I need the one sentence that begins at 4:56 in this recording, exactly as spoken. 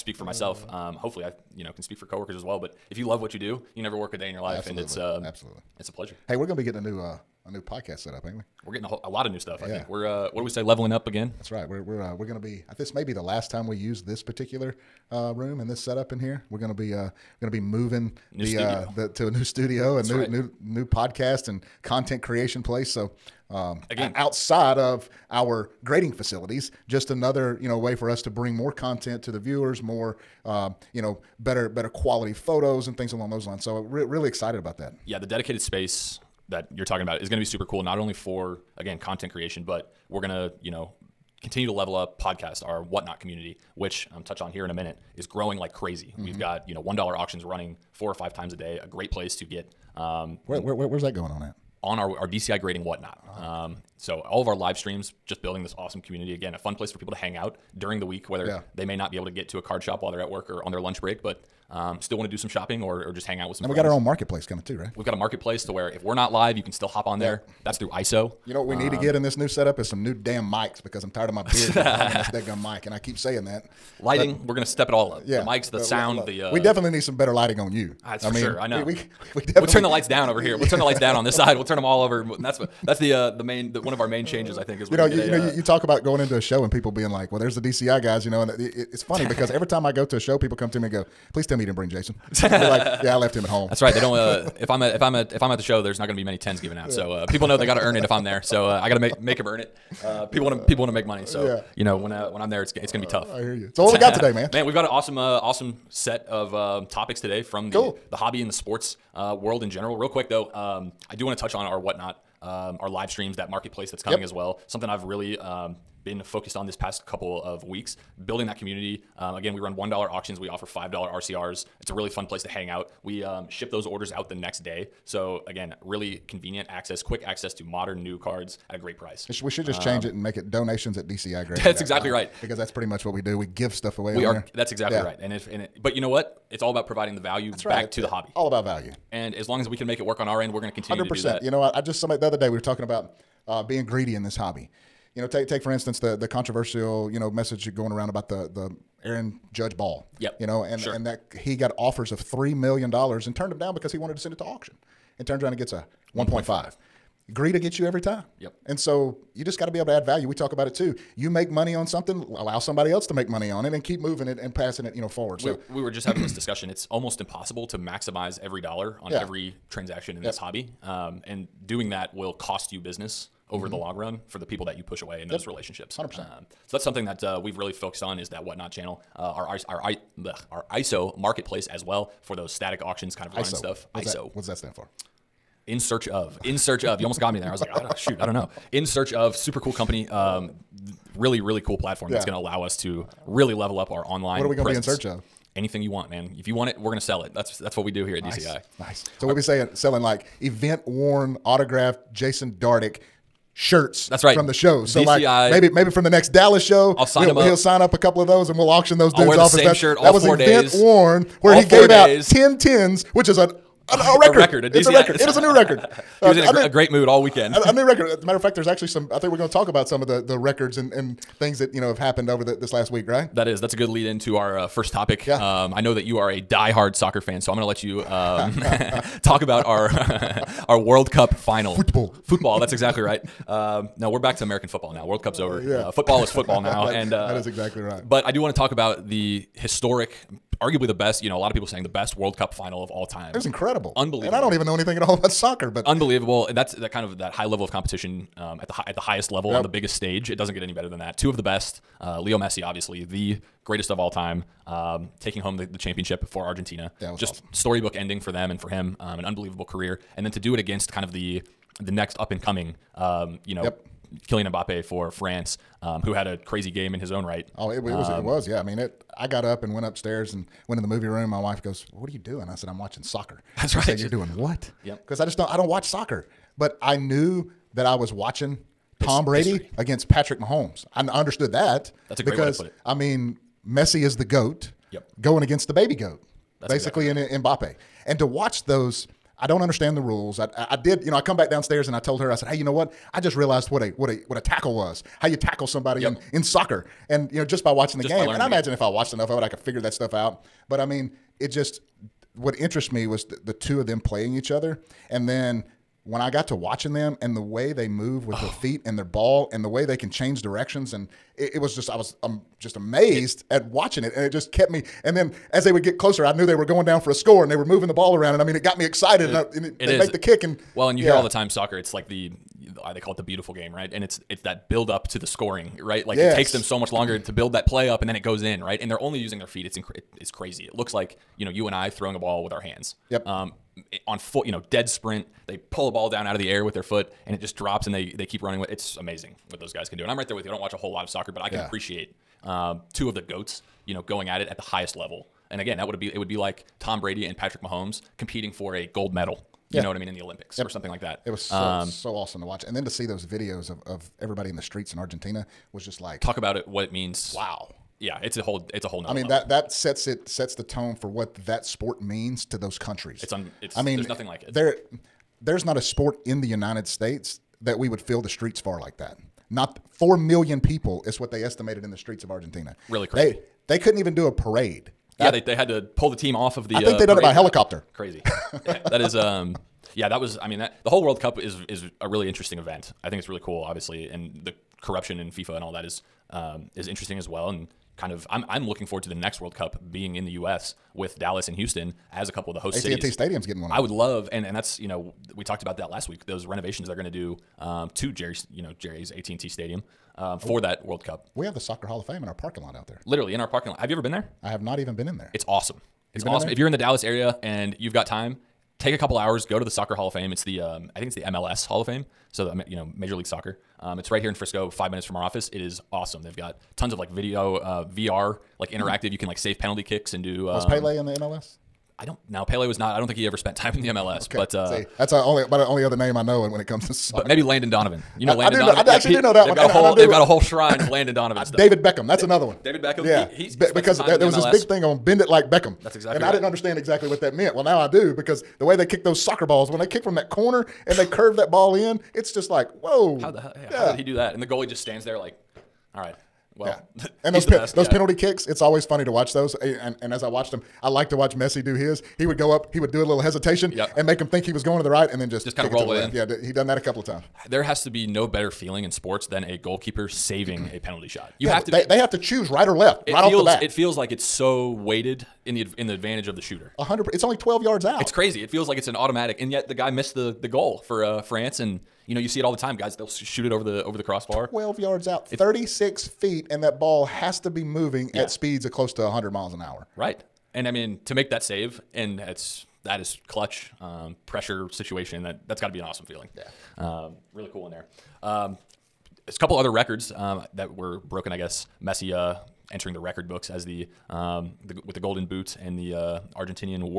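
in, in soccer and you know just by watching the just game.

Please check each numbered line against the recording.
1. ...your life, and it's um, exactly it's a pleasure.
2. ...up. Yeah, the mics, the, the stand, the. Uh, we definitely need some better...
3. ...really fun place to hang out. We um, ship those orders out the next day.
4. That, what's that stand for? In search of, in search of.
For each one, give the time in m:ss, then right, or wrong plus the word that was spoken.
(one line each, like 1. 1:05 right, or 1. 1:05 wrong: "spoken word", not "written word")
1. 0:04 wrong: "absolutely", not "exactly"
2. 1:15 wrong: "sound", not "stand"
3. 2:01 right
4. 3:04 right.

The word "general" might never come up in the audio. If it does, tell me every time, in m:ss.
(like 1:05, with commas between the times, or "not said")
1:49.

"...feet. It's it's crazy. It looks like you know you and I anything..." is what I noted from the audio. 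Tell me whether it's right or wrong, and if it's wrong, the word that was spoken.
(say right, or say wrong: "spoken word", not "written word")
wrong: "throwing", not "anything".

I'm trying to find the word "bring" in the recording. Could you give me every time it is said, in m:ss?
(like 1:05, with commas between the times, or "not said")
0:28, 1:31.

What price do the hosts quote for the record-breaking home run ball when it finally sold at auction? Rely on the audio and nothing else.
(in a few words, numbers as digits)
1.5 million.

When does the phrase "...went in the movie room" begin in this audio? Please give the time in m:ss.
4:30.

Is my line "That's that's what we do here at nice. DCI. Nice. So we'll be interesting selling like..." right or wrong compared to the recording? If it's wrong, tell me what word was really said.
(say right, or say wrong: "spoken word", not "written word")
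wrong: "saying", not "interesting".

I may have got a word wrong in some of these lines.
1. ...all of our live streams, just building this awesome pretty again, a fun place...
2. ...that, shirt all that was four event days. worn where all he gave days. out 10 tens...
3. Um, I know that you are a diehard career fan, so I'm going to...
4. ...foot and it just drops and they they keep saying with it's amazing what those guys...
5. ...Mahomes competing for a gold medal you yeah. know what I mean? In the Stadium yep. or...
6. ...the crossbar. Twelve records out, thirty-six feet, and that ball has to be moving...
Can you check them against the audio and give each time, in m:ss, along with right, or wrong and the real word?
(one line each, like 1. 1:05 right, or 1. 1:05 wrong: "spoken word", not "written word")
1. 0:54 wrong: "community", not "pretty"
2. 3:29 right
3. 3:45 wrong: "soccer", not "career"
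4. 5:36 wrong: "running", not "saying"
5. 5:47 wrong: "Olympics", not "Stadium"
6. 7:53 wrong: "yards", not "records".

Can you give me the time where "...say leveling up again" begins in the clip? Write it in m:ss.
0:10.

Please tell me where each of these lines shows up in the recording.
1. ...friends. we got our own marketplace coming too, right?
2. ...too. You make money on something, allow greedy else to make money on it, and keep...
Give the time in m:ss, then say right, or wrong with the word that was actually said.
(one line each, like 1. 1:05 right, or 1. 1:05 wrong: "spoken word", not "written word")
1. 1:03 right
2. 2:40 wrong: "somebody", not "greedy".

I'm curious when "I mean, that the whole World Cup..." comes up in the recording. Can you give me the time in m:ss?
6:20.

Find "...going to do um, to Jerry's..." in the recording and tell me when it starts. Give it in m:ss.
6:36.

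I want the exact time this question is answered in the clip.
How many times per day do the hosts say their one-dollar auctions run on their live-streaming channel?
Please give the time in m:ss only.
0:47.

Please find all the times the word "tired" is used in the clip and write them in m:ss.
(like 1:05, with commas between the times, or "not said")
1:11.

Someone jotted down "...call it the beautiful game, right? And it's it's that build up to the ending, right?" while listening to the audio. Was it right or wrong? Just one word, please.
wrong.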